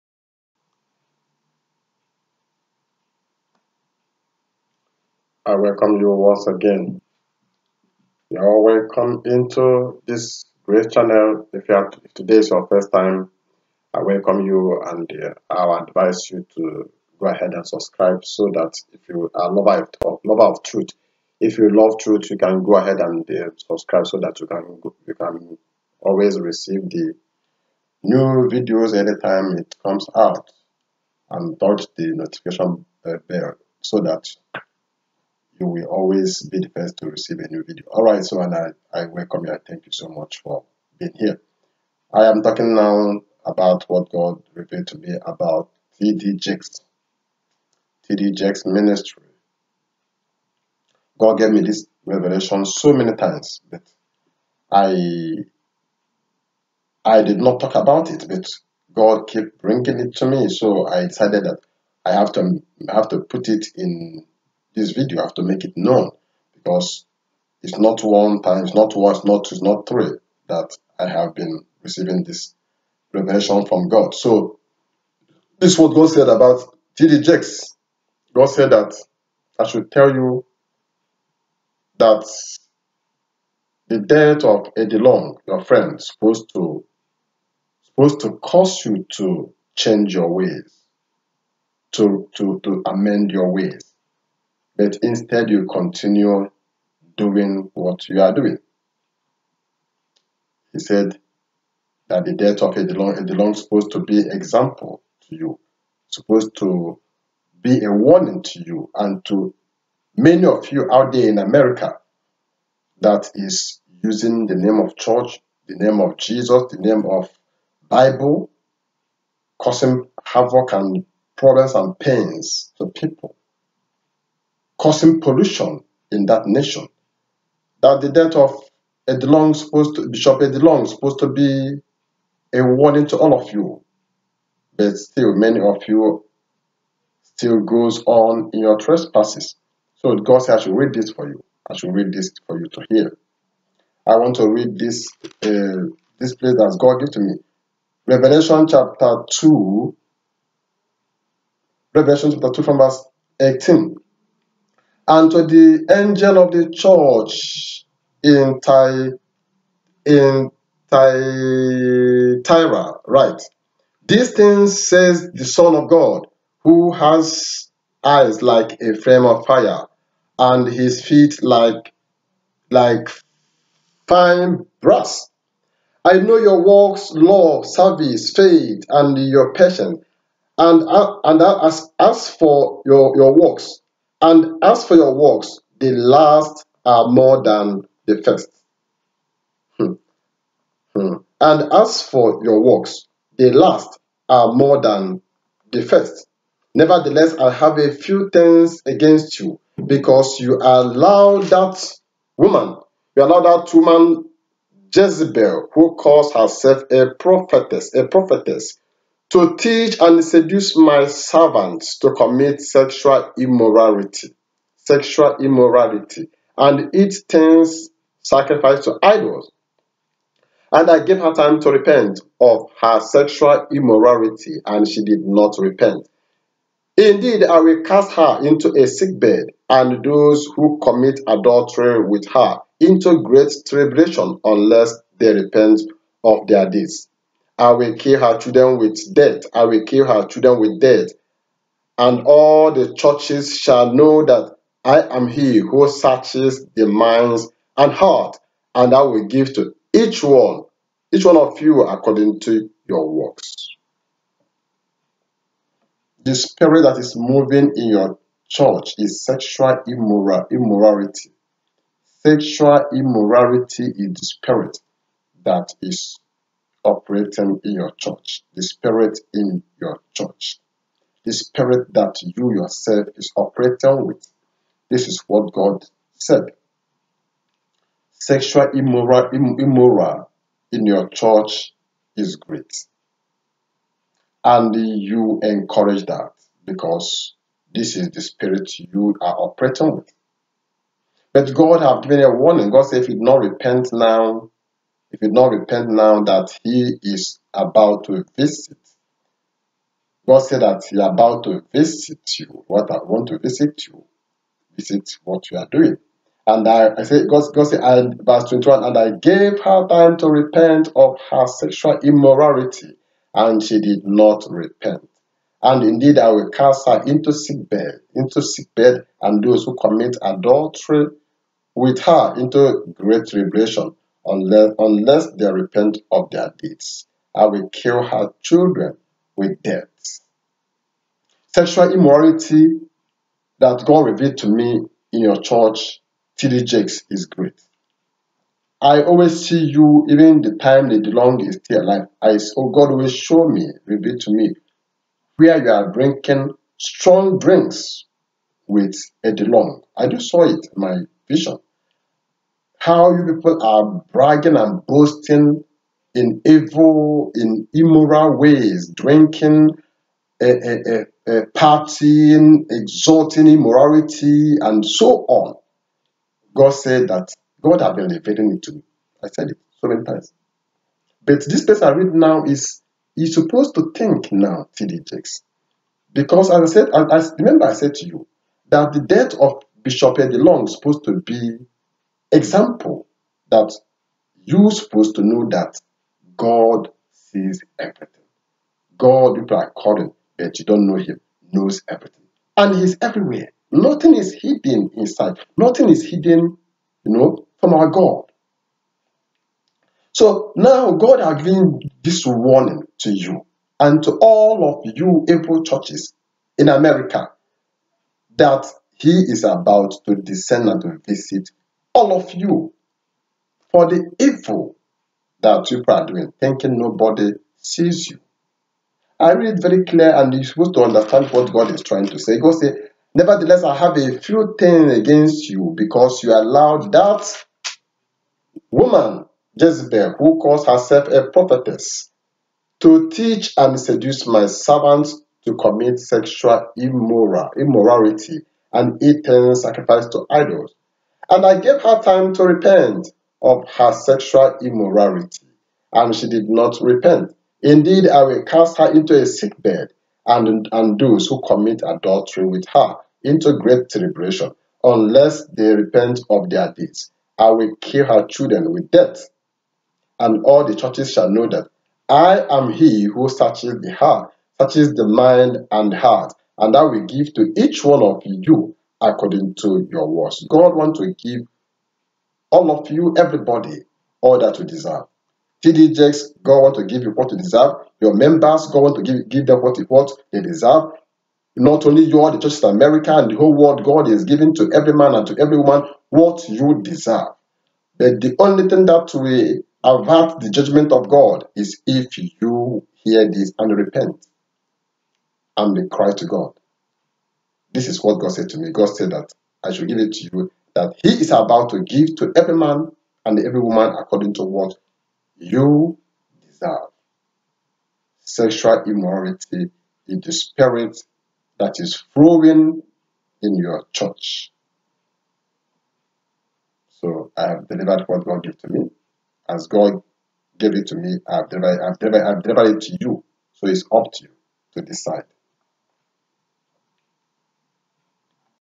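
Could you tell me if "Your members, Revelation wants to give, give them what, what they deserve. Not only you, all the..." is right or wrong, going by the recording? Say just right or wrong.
wrong.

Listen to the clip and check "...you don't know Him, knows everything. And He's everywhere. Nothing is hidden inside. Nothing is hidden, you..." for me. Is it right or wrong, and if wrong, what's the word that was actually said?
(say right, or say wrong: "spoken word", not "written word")
right.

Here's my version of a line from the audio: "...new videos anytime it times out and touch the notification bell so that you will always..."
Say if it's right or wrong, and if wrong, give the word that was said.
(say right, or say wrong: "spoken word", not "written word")
wrong: "comes", not "times".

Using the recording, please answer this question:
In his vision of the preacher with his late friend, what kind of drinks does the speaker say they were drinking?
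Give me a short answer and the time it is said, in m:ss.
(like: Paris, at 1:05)
strong drinks, at 5:46.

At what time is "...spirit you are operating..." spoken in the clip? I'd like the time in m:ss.
4:48.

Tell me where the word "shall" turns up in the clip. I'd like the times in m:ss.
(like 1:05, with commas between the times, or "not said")
4:03, 7:41.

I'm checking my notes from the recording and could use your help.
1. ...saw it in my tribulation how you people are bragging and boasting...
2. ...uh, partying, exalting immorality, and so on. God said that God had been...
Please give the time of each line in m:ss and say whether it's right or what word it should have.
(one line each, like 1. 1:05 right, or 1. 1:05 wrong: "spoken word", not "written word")
1. 5:50 wrong: "vision", not "tribulation"
2. 6:01 right.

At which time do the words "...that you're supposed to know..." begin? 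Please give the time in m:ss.
6:23.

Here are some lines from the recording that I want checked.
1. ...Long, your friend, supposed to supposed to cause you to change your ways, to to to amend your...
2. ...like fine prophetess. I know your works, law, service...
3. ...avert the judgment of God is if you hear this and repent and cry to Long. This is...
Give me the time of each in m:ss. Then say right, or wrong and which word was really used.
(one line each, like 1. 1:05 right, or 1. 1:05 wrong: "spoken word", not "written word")
1. 1:24 right
2. 2:52 wrong: "brass", not "prophetess"
3. 8:09 wrong: "God", not "Long".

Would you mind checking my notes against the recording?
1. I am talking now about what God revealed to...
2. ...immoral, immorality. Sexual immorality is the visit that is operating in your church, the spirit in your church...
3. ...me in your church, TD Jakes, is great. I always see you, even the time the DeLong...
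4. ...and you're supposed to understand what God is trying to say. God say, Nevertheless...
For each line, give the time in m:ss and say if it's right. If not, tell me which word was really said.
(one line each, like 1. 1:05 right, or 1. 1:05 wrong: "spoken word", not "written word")
1. 0:42 right
2. 4:19 wrong: "spirit", not "visit"
3. 5:34 right
4. 7:00 right.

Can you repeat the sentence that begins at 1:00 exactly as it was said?
So I decided that I have to I have to put it in this video.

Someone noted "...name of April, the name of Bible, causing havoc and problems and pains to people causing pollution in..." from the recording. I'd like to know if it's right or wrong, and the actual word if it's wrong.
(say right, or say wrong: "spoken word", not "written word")
wrong: "Jesus", not "April".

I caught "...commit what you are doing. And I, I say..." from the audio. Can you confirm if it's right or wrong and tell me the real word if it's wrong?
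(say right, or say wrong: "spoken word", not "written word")
wrong: "visit", not "commit".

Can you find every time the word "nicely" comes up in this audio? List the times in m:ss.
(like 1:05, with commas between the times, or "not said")
not said.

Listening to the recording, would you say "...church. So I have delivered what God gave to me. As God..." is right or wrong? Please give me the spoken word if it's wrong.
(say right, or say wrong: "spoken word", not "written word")
right.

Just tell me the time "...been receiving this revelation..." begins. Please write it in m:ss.
1:11.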